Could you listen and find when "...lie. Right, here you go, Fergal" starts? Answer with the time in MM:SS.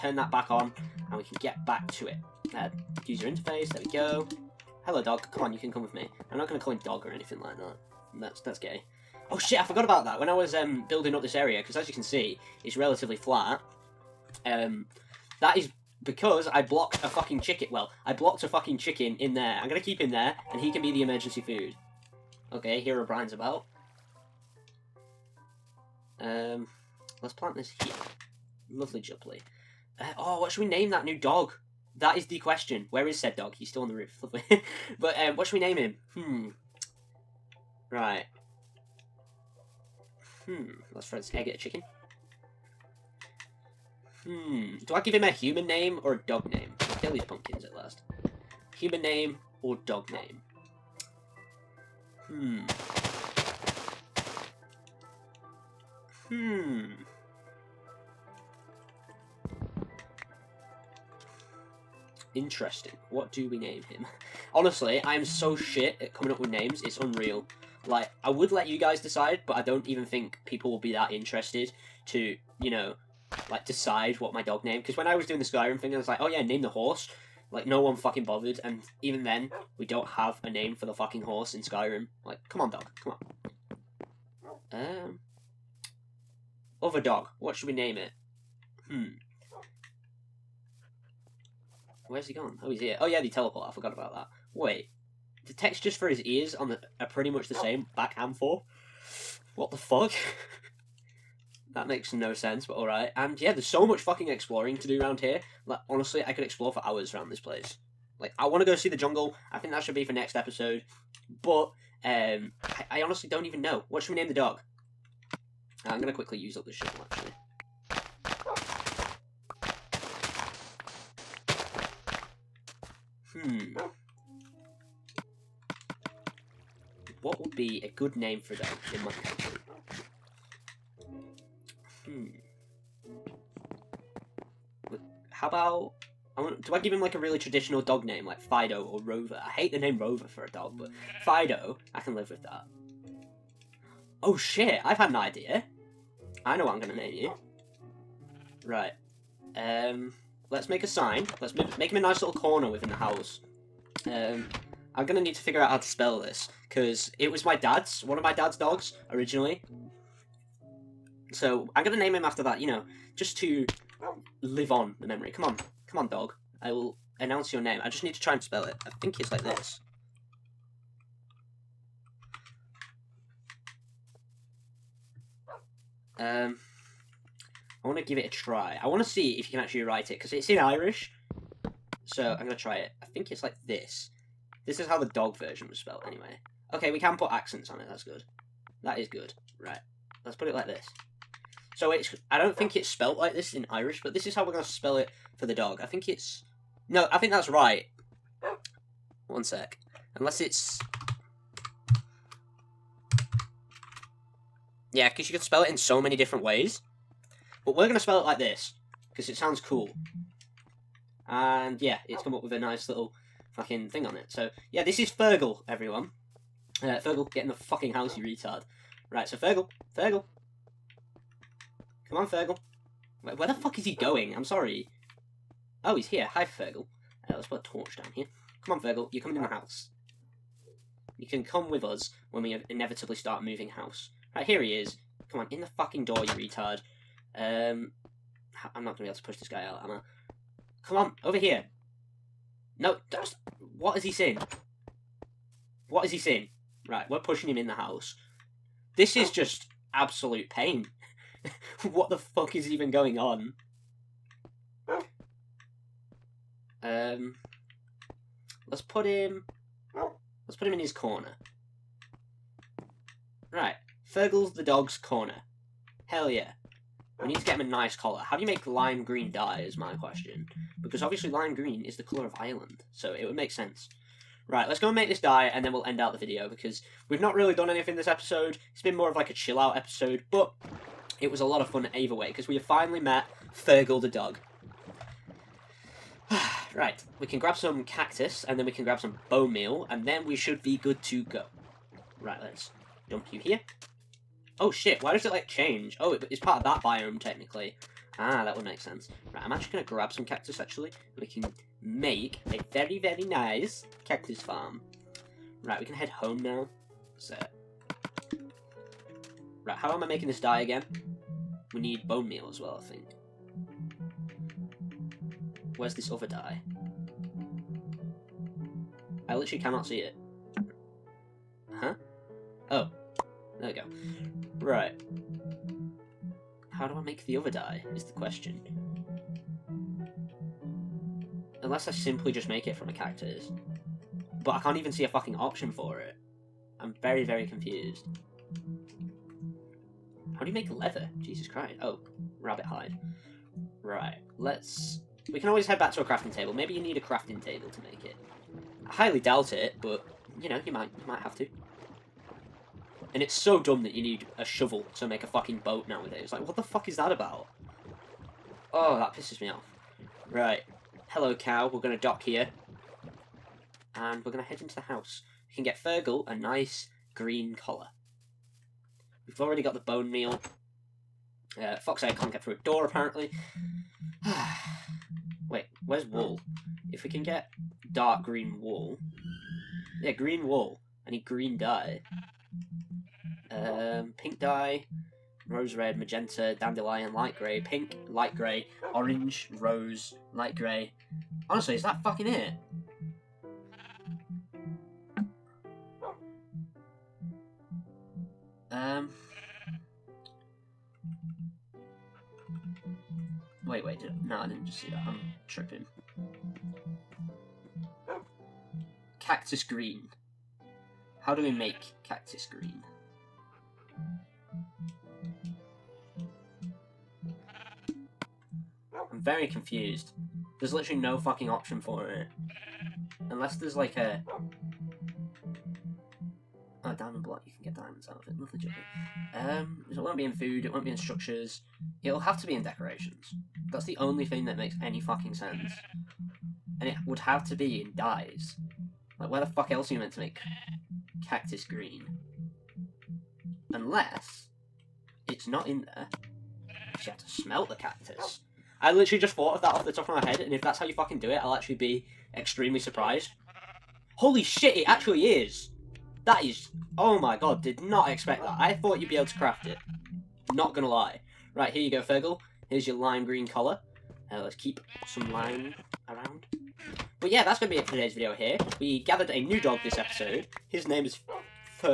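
07:40.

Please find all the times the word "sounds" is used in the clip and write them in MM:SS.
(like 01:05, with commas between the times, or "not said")
03:29.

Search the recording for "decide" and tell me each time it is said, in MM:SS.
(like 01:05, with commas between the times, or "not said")
01:08, 01:13.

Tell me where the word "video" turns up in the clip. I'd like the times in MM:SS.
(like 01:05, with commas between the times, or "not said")
04:36, 07:48.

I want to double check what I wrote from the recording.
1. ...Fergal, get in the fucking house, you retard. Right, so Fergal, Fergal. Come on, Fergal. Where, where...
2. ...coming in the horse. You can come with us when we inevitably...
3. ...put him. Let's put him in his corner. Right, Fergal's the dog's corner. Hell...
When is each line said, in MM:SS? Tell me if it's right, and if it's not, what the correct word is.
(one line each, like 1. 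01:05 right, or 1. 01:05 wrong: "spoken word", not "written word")
1. 03:36 right
2. 03:49 wrong: "house", not "horse"
3. 04:18 right.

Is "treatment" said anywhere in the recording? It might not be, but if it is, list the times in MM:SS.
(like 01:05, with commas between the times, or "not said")
not said.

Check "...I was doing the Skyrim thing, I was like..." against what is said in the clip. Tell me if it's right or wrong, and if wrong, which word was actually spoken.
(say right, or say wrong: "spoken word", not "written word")
right.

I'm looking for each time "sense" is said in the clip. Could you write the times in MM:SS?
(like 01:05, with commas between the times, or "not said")
01:42, 04:33, 04:58, 07:15.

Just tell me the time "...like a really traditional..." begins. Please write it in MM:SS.
02:17.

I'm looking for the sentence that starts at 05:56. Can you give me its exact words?
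Like, what the fuck is that about?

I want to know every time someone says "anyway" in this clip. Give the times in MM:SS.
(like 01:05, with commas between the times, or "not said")
03:06.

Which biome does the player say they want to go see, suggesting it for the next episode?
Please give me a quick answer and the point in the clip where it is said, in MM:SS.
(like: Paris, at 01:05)
The jungle, at 01:48.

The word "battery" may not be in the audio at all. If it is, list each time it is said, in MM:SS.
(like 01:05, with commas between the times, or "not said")
not said.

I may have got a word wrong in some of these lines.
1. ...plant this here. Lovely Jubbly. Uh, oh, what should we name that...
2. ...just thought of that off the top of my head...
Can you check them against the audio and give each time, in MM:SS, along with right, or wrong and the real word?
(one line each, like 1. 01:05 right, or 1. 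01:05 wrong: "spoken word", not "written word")
1. 00:27 right
2. 07:29 right.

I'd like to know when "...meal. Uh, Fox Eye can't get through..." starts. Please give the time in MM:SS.
06:10.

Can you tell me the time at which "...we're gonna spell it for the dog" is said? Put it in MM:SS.
03:14.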